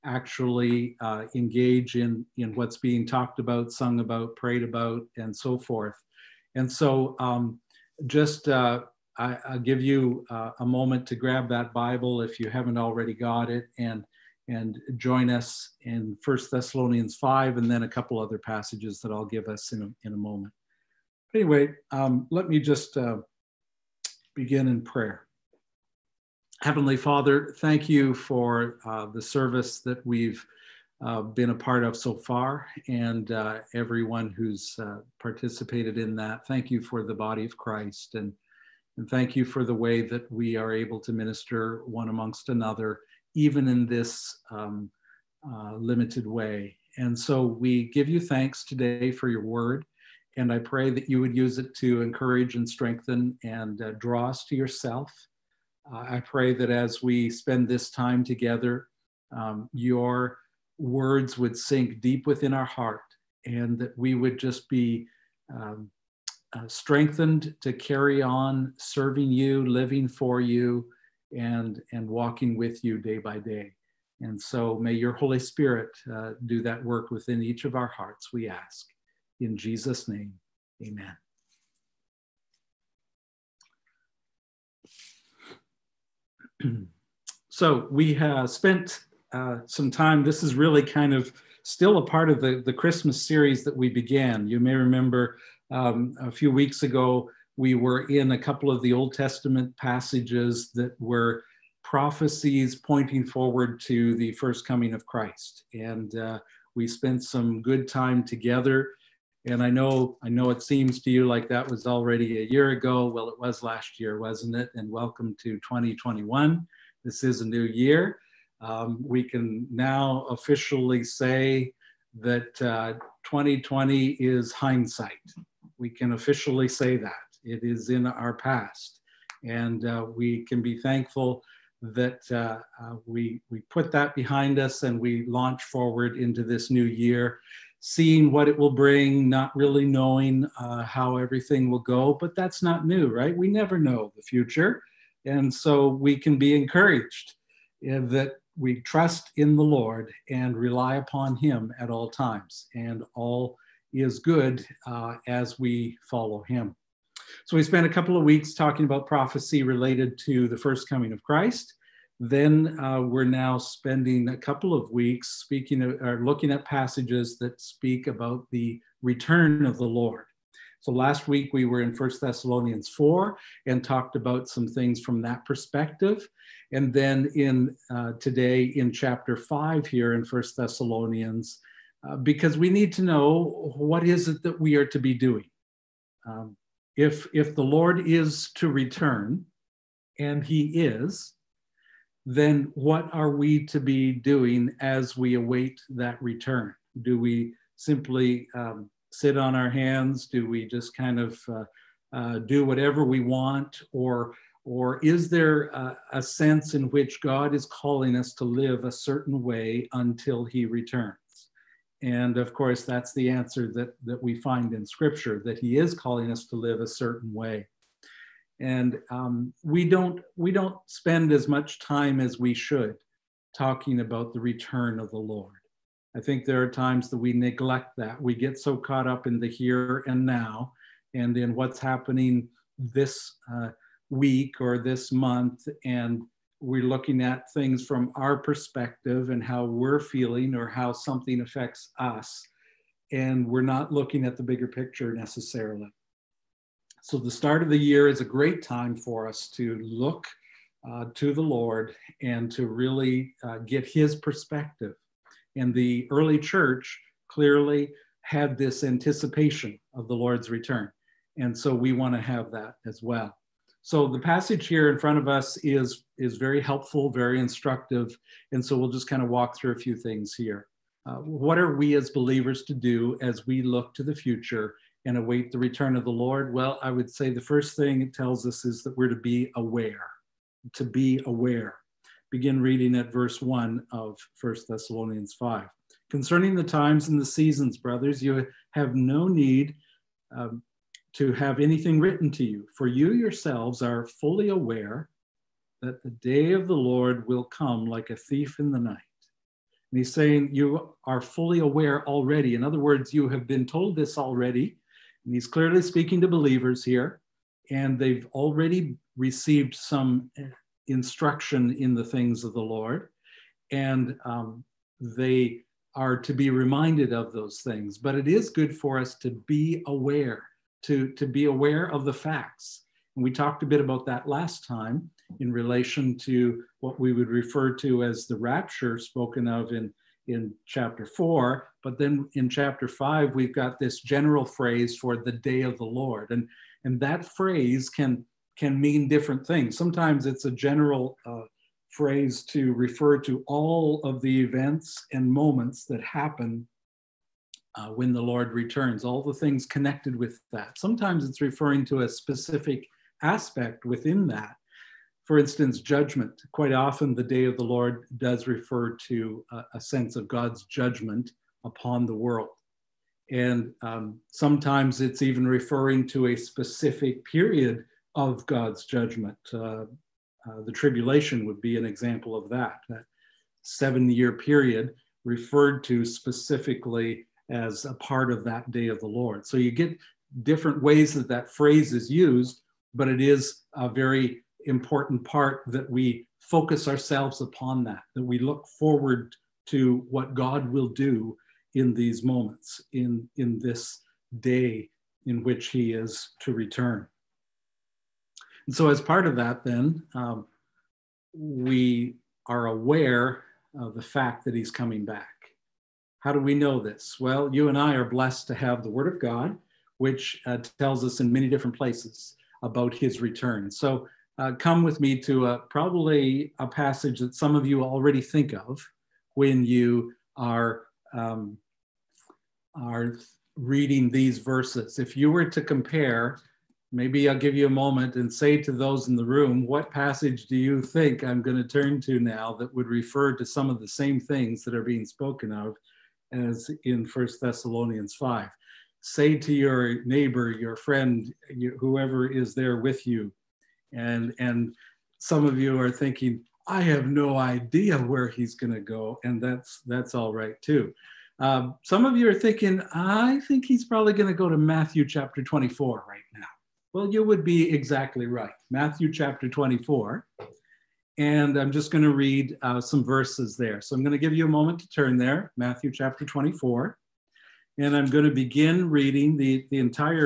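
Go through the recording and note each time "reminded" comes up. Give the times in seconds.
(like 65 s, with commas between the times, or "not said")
316 s.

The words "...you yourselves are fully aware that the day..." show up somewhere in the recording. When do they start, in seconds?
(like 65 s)
292 s.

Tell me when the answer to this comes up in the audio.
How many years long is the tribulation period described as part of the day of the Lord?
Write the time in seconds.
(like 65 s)
373 s.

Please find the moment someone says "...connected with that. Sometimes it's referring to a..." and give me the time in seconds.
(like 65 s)
349 s.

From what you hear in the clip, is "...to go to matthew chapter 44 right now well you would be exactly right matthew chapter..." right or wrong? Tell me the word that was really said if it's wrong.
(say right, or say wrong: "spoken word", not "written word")
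wrong: "24", not "44".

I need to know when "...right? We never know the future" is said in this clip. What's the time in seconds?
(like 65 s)
143 s.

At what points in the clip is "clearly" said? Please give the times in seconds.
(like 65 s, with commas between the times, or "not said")
257 s, 305 s.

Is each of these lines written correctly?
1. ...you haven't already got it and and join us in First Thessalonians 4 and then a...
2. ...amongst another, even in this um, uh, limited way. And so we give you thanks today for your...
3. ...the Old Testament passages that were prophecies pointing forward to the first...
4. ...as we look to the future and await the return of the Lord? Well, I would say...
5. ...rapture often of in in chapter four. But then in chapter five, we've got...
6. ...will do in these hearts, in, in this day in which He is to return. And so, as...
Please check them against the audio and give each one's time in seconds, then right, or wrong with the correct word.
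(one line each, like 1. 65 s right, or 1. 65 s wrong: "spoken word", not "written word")
1. 12 s wrong: "5", not "4"
2. 42 s right
3. 98 s right
4. 273 s right
5. 328 s wrong: "spoken", not "often"
6. 390 s wrong: "moments", not "hearts".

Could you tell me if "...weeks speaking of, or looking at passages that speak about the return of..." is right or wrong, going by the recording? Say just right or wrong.
right.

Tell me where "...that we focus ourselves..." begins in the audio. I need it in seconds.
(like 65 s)
385 s.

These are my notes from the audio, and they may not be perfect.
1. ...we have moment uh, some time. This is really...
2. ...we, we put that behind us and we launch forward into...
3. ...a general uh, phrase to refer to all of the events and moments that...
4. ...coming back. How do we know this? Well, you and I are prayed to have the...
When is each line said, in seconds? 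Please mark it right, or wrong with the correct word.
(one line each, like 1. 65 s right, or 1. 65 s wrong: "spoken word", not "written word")
1. 87 s wrong: "spent", not "moment"
2. 133 s right
3. 340 s right
4. 404 s wrong: "blessed", not "prayed".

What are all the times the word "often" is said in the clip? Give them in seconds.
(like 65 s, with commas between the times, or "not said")
356 s.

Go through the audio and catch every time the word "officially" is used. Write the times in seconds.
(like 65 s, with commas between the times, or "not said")
120 s, 126 s.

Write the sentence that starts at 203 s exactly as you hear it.
Or, or is there a, a sense in which God is calling us to live a certain way until he returns?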